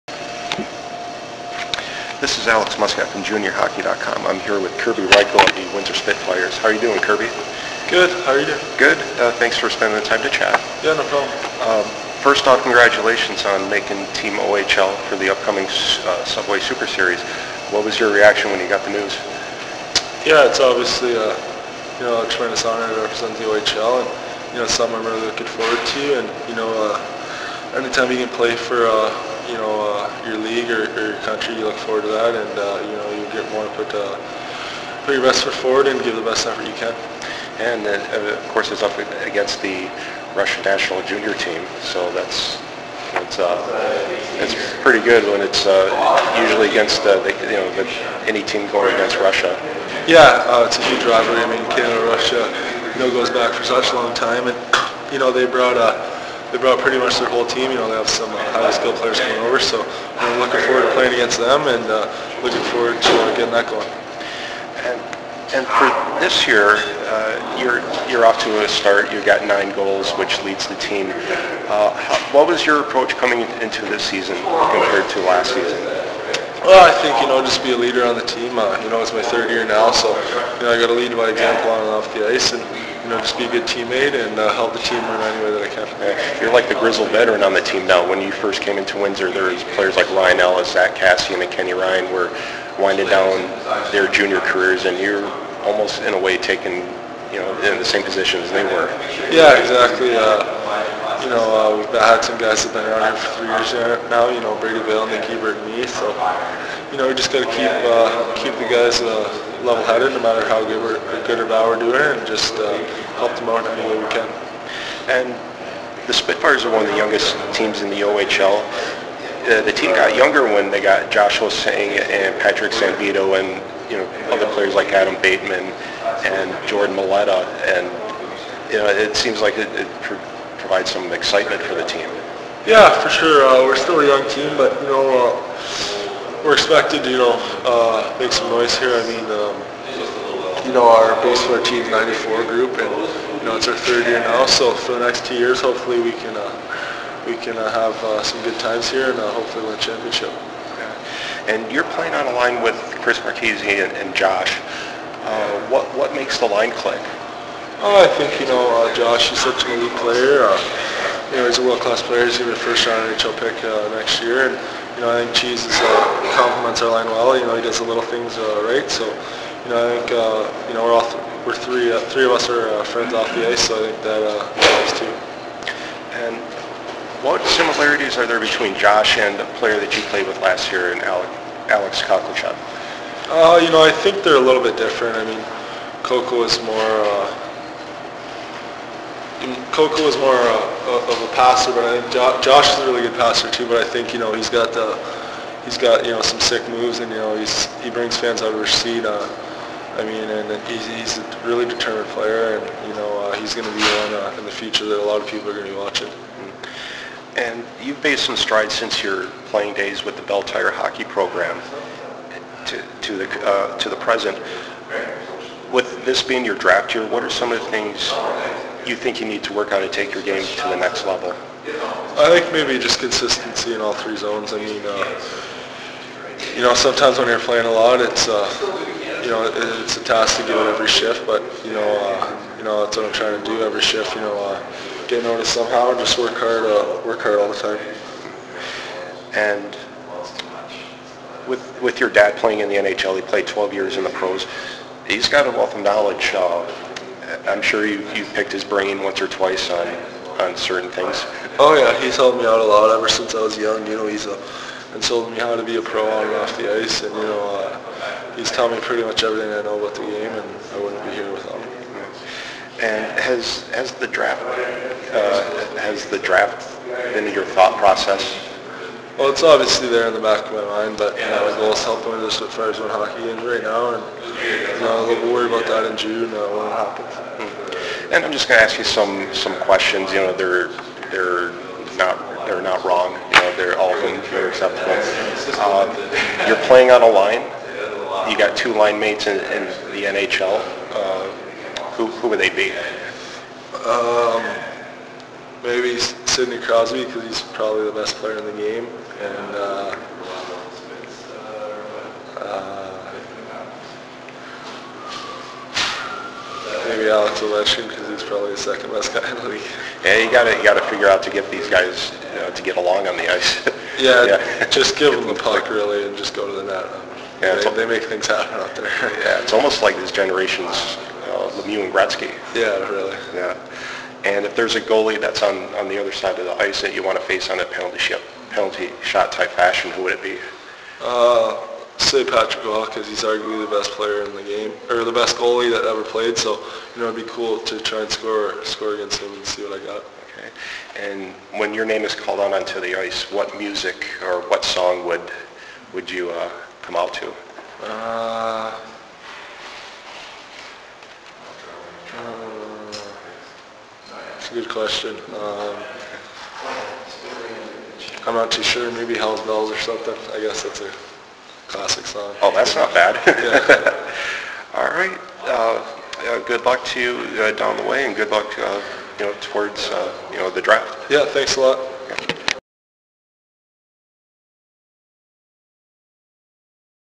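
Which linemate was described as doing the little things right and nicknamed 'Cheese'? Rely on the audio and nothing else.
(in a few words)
Chris Marchese.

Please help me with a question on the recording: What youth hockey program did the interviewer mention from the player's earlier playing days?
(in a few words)
Belle Tire.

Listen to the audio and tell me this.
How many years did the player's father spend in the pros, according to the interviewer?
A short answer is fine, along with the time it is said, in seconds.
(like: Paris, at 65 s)
12, at 243 s.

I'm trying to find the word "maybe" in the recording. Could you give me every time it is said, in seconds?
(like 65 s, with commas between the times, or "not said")
222 s, 295 s, 306 s, 358 s.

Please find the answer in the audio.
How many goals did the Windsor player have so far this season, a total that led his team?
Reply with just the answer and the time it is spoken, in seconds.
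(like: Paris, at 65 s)
9, at 69 s.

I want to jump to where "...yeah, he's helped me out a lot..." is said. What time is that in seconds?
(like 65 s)
251 s.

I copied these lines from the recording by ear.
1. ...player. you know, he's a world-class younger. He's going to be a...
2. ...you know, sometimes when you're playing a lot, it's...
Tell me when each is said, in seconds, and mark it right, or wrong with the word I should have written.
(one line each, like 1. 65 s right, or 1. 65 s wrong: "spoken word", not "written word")
1. 159 s wrong: "player", not "younger"
2. 226 s right.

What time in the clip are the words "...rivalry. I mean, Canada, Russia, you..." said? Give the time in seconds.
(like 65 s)
51 s.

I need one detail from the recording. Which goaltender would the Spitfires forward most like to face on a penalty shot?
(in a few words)
Patrick Roy.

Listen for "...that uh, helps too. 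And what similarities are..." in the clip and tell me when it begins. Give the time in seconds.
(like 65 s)
174 s.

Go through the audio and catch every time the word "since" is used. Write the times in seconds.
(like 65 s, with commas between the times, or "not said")
208 s, 253 s.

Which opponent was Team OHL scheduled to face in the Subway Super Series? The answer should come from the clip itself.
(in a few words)
Russian national junior team.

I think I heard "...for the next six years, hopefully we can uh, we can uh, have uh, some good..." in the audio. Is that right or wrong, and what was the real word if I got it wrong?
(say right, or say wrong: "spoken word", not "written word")
wrong: "two", not "six".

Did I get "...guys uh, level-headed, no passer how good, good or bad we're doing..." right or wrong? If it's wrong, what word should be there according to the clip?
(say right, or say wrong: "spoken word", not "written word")
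wrong: "matter", not "passer".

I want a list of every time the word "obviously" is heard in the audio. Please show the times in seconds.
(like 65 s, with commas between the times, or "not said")
20 s, 269 s.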